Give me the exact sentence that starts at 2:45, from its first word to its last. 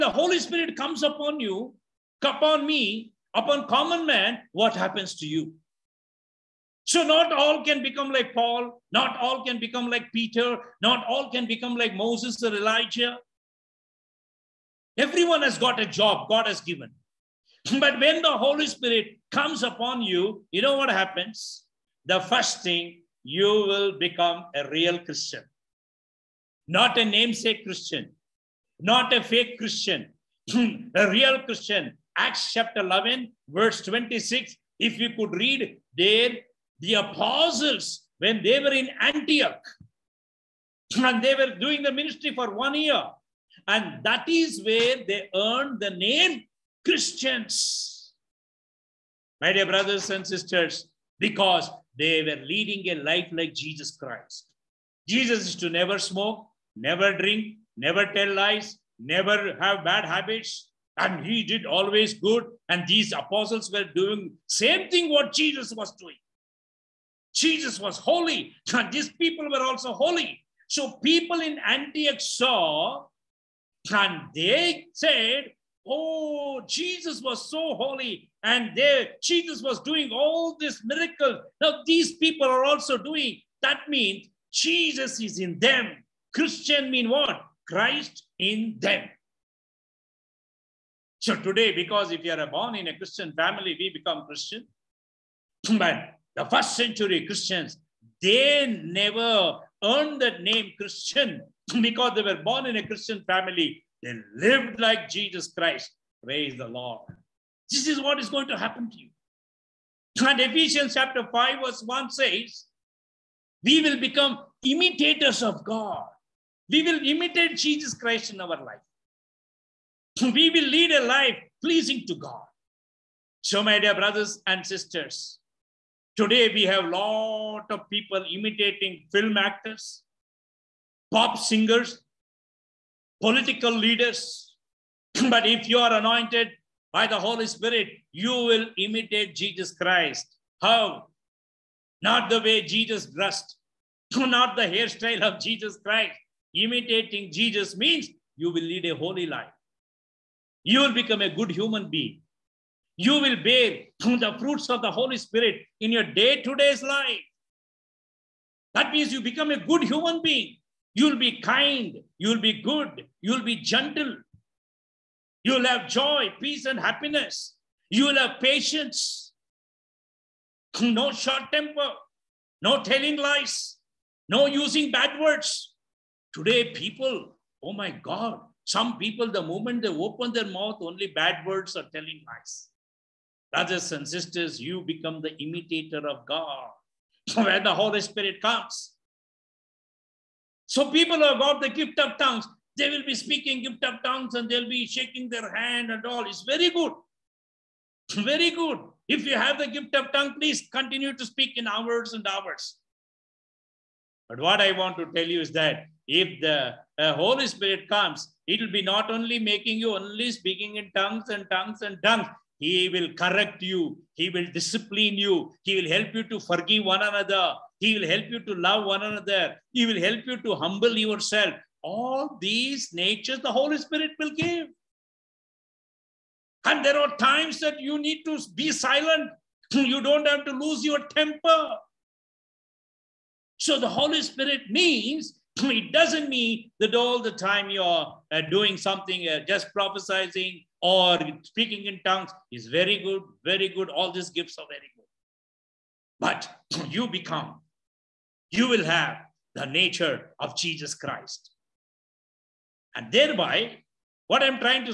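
You'll have joy, peace, and happiness.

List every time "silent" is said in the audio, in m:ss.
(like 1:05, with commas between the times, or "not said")
3:48.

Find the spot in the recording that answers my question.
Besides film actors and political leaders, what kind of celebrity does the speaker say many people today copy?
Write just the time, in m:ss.
2:11.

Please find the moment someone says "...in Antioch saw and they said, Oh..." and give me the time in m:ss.
1:11.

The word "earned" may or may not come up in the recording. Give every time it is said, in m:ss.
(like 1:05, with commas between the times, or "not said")
0:45, 1:39.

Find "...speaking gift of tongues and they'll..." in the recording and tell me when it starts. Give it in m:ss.
3:13.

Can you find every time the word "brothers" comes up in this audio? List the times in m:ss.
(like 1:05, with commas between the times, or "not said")
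0:49, 2:03, 3:03.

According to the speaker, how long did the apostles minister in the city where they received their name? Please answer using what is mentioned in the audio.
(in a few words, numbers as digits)
1 year.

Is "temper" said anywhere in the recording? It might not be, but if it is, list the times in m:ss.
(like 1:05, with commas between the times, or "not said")
2:51, 3:51.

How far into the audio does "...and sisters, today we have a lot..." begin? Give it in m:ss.
2:04.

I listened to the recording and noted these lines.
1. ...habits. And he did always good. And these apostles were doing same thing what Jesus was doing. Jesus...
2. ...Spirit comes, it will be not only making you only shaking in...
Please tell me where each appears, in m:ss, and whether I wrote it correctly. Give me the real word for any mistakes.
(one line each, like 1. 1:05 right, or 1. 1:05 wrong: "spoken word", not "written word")
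1. 1:00 right
2. 3:27 wrong: "speaking", not "shaking".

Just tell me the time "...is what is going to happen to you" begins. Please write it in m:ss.
1:47.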